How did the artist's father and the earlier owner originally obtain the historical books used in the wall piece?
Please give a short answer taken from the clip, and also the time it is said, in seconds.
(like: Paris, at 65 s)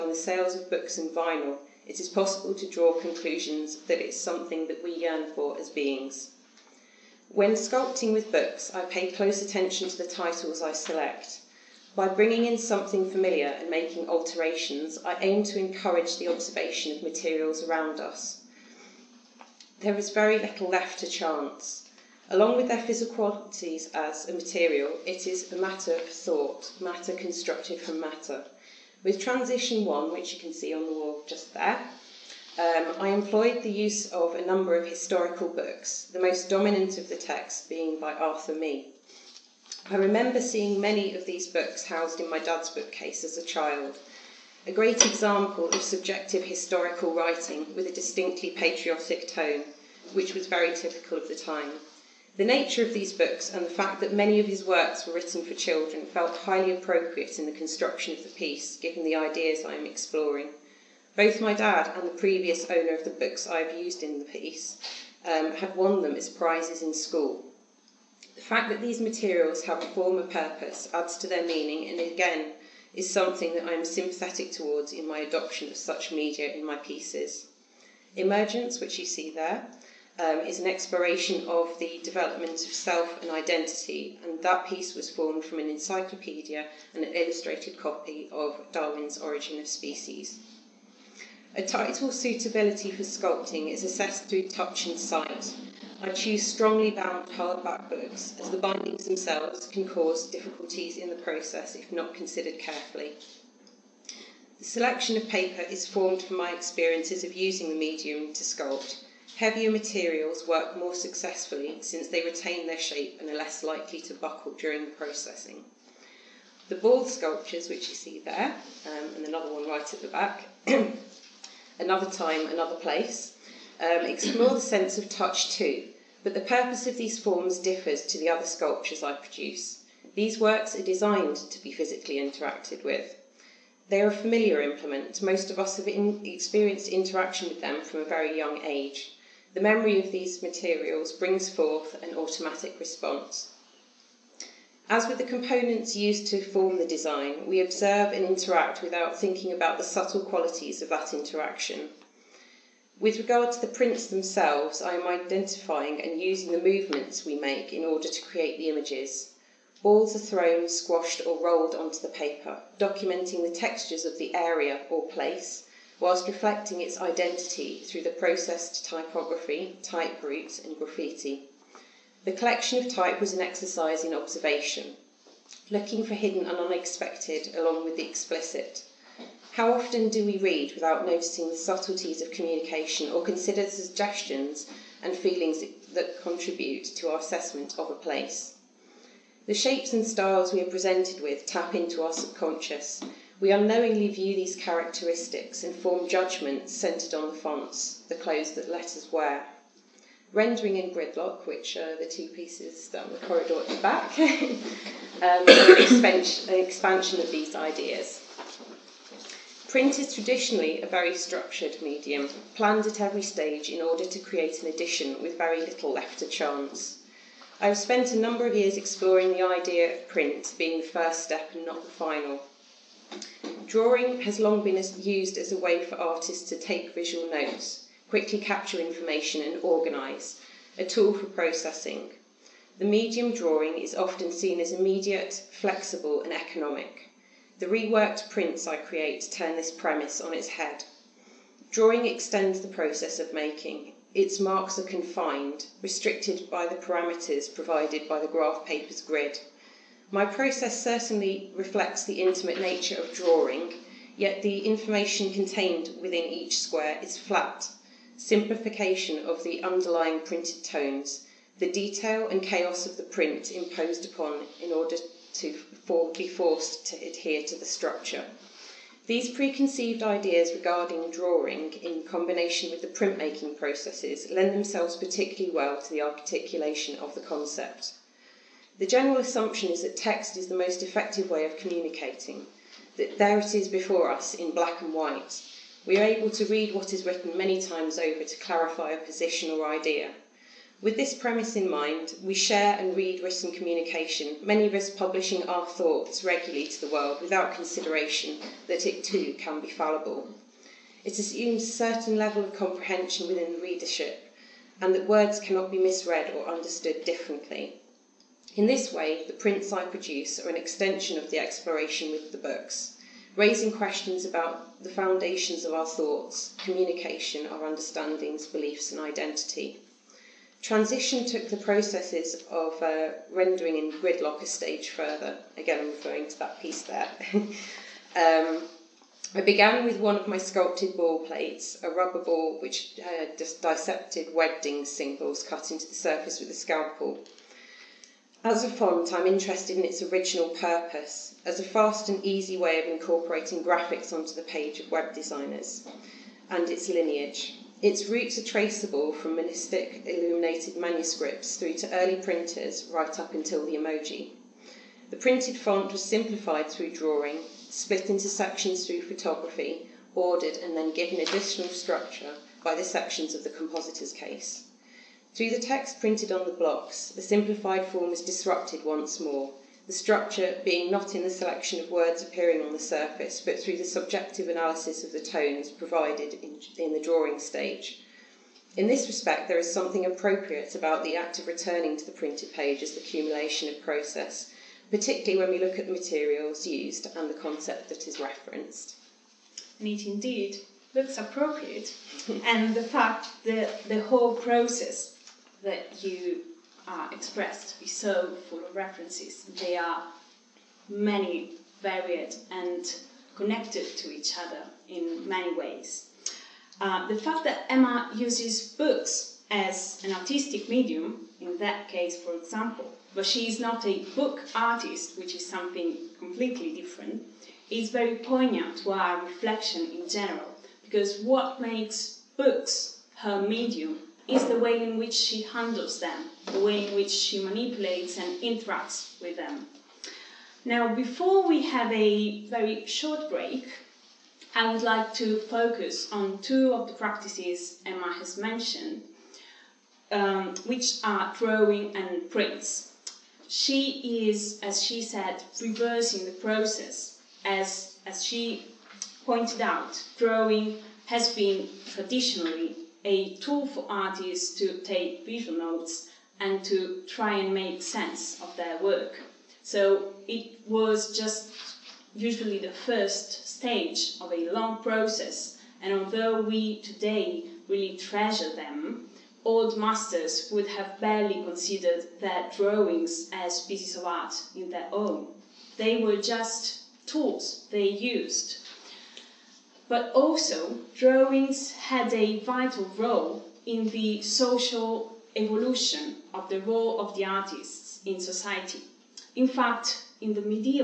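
won them as prizes, at 65 s.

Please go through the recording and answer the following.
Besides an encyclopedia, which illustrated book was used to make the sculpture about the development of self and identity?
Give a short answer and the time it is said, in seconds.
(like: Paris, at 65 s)
Origin of Species, at 89 s.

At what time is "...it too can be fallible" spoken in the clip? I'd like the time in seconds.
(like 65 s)
298 s.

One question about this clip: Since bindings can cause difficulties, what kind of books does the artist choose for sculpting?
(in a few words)
strongly bound hardback.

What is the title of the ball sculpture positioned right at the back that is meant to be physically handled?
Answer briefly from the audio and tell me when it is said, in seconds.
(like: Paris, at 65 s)
Another Time, Another Place, at 121 s.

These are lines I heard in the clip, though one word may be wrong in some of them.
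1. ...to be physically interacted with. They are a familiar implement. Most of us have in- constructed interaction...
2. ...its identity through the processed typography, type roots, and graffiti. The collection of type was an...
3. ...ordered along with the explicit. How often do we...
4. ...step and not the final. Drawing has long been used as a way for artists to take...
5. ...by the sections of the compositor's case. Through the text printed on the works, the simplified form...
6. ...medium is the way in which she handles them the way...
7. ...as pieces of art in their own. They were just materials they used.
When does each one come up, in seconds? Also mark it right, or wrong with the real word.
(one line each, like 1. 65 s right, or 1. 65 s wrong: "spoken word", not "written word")
1. 131 s wrong: "experienced", not "constructed"
2. 166 s right
3. 176 s wrong: "unexpected", not "ordered"
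4. 221 s right
5. 362 s wrong: "blocks", not "works"
6. 423 s right
7. 473 s wrong: "tools", not "materials".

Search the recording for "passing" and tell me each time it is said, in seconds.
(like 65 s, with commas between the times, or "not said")
not said.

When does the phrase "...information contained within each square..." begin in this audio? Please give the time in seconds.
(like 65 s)
254 s.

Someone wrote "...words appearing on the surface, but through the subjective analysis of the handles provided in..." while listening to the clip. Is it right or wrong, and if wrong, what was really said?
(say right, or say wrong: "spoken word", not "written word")
wrong: "tones", not "handles".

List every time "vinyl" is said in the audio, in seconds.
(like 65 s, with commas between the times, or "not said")
1 s.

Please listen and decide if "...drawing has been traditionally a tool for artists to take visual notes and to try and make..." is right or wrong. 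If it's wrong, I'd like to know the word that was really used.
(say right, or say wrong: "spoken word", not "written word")
right.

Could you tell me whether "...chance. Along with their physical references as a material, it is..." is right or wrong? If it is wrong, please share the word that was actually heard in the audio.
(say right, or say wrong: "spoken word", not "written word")
wrong: "qualities", not "references".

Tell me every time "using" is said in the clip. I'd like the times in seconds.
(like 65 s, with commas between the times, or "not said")
107 s, 156 s.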